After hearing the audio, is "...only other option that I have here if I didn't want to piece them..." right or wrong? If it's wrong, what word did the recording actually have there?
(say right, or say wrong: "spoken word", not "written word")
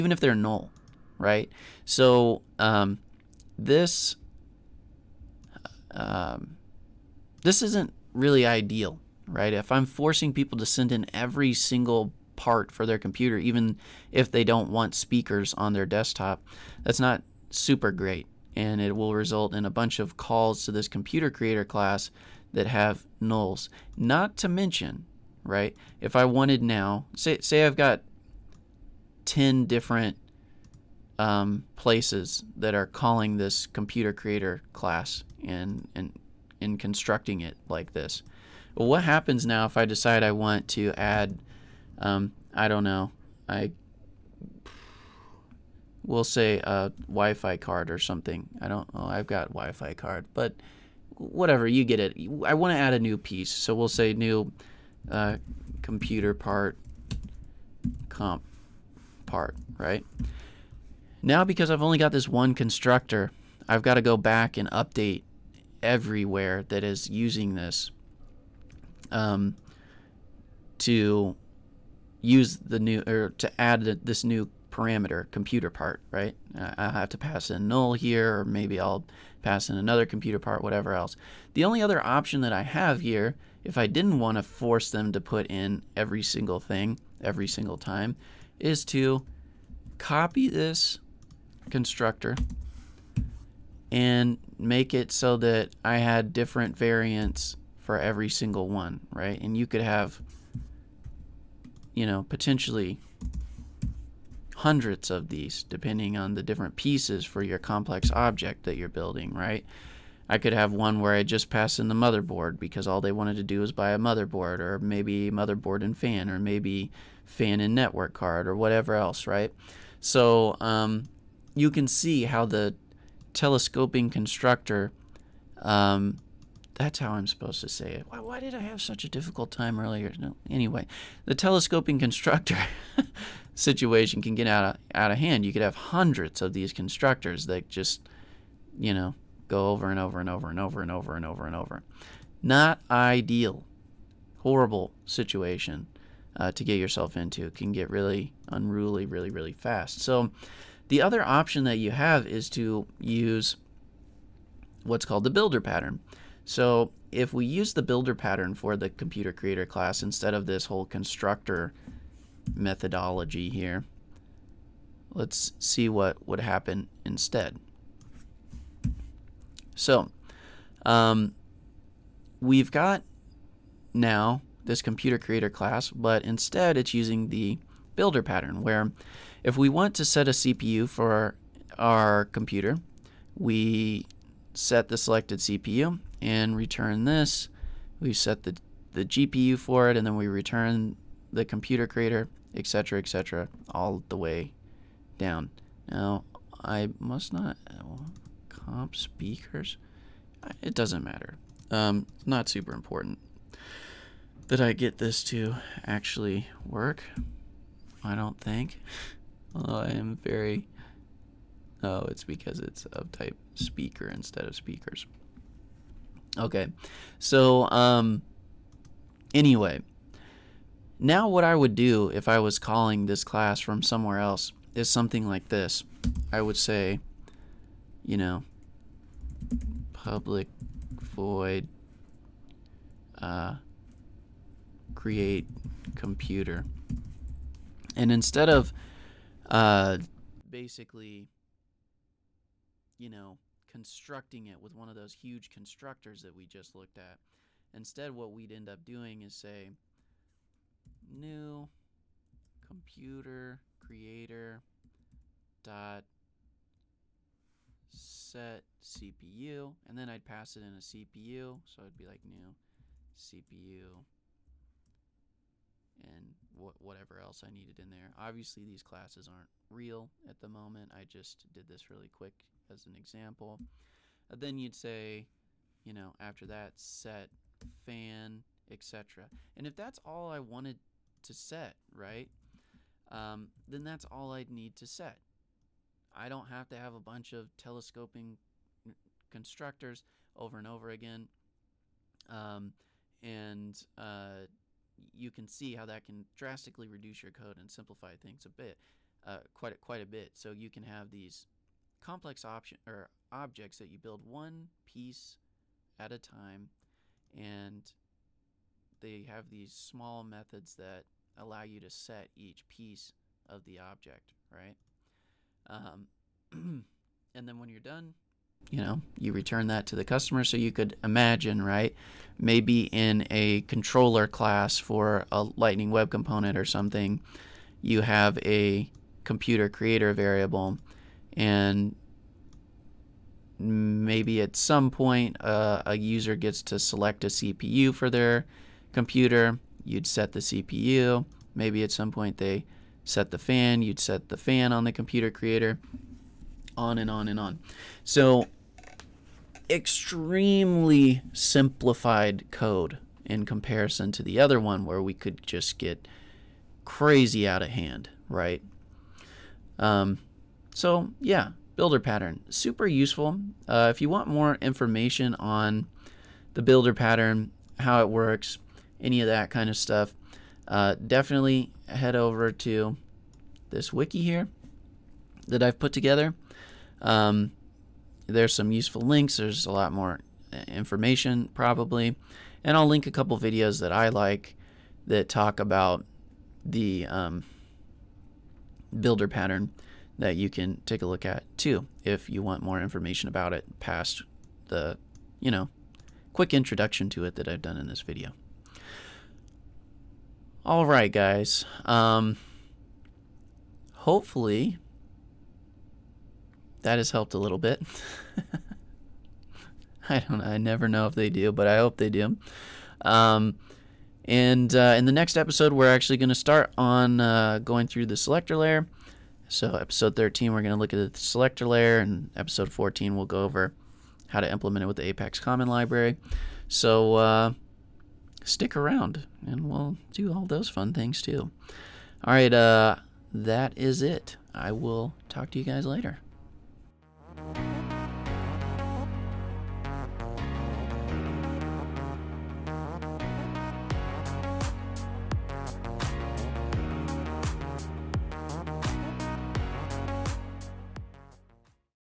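wrong: "force", not "piece".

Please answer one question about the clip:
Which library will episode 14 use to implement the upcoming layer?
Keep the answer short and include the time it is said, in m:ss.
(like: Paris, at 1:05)
Apex Common Library, at 7:05.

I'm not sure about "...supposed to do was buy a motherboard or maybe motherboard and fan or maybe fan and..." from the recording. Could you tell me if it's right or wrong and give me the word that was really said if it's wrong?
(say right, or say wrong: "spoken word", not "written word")
wrong: "wanted", not "supposed".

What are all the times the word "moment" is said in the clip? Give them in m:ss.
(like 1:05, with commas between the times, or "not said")
4:30.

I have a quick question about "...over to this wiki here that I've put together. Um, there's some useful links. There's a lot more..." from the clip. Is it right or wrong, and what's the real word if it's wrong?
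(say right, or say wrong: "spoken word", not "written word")
right.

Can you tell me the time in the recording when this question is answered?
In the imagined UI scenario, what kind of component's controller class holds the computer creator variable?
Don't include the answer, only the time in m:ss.
5:25.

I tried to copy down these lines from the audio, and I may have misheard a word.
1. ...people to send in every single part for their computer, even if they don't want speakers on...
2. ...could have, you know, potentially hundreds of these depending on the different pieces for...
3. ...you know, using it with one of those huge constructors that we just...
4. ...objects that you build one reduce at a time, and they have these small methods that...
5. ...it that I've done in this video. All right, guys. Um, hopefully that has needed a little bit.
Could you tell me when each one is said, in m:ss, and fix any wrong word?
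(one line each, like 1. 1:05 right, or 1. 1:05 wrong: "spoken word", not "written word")
1. 0:10 right
2. 1:39 right
3. 4:02 wrong: "constructing", not "using"
4. 5:03 wrong: "piece", not "reduce"
5. 6:37 wrong: "helped", not "needed".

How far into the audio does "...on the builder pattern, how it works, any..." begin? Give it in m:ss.
6:05.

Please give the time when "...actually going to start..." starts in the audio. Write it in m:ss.
6:55.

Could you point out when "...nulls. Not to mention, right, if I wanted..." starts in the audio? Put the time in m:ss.
0:23.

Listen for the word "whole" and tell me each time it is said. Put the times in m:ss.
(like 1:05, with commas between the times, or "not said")
2:40.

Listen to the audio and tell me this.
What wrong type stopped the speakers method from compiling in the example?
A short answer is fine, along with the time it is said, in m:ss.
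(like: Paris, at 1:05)
speaker instead of speakers, at 3:33.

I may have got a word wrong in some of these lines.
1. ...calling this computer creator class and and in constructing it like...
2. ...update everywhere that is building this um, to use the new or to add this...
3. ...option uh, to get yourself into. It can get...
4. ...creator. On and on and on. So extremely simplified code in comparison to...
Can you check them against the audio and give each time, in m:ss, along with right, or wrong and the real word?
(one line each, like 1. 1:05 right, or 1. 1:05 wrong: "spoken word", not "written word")
1. 0:32 right
2. 1:04 wrong: "using", not "building"
3. 2:25 wrong: "situation", not "option"
4. 5:45 right.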